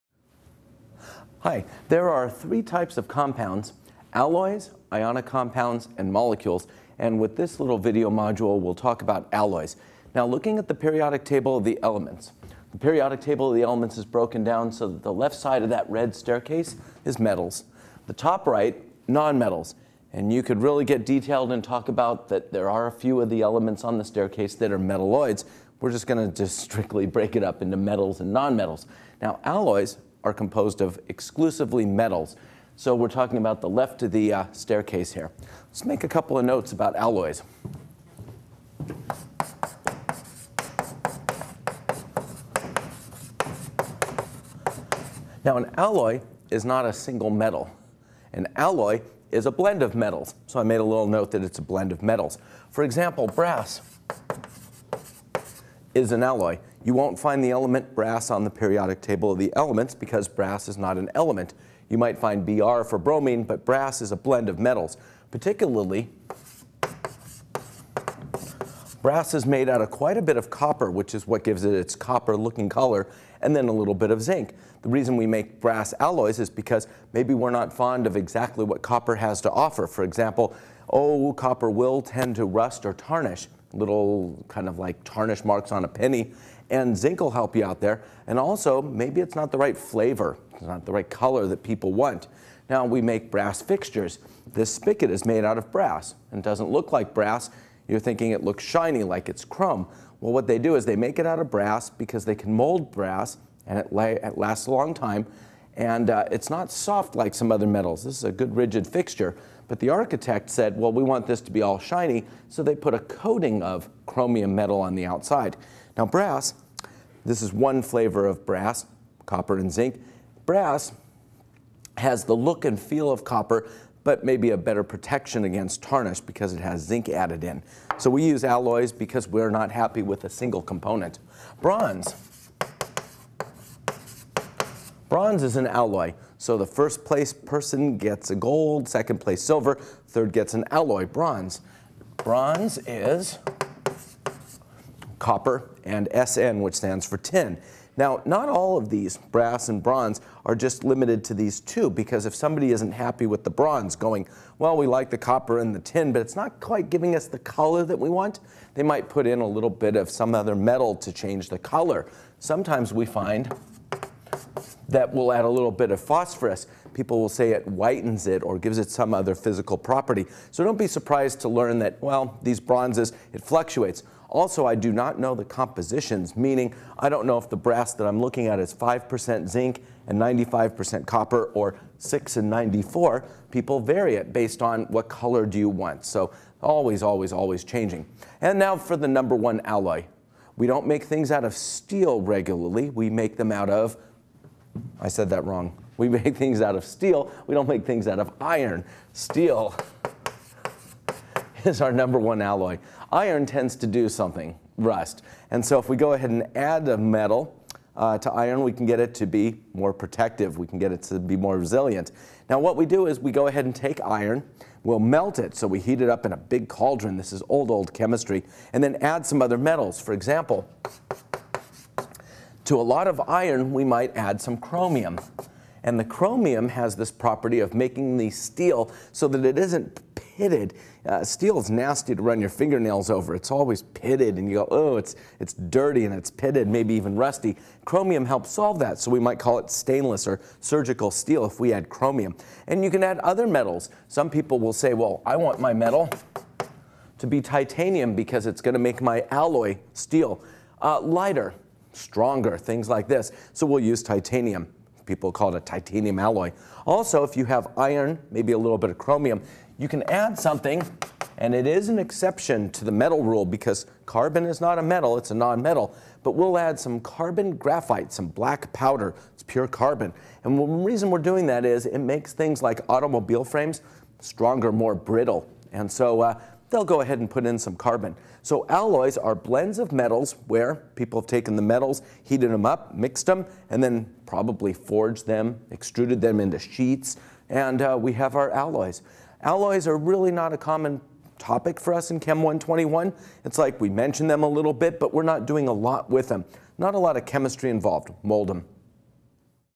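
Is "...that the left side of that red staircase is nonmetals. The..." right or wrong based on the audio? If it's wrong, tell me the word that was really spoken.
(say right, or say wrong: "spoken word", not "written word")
wrong: "metals", not "nonmetals".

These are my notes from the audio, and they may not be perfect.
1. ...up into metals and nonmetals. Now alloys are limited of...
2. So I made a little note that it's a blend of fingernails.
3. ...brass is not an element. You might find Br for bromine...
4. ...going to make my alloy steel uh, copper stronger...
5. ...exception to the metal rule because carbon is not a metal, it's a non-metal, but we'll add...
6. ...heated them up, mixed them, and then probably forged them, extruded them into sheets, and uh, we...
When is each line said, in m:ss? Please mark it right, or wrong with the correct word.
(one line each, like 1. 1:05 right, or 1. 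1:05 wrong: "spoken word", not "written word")
1. 0:27 wrong: "composed", not "limited"
2. 0:50 wrong: "metals", not "fingernails"
3. 1:00 right
4. 4:08 wrong: "lighter", not "copper"
5. 4:21 right
6. 4:42 right.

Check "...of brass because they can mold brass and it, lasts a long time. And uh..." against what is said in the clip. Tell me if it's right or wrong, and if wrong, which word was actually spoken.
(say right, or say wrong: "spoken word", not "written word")
right.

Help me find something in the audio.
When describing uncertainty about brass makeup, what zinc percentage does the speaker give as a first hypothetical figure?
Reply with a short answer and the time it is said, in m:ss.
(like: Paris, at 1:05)
5%, at 2:58.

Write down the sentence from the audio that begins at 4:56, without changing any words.
Not a lot of chemistry involved.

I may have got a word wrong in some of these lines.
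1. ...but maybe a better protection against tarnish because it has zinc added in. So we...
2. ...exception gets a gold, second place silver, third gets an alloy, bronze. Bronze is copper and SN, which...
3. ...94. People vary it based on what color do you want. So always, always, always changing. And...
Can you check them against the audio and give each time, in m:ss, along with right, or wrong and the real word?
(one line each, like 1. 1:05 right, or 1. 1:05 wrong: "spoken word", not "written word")
1. 2:04 right
2. 2:17 wrong: "person", not "exception"
3. 3:02 right.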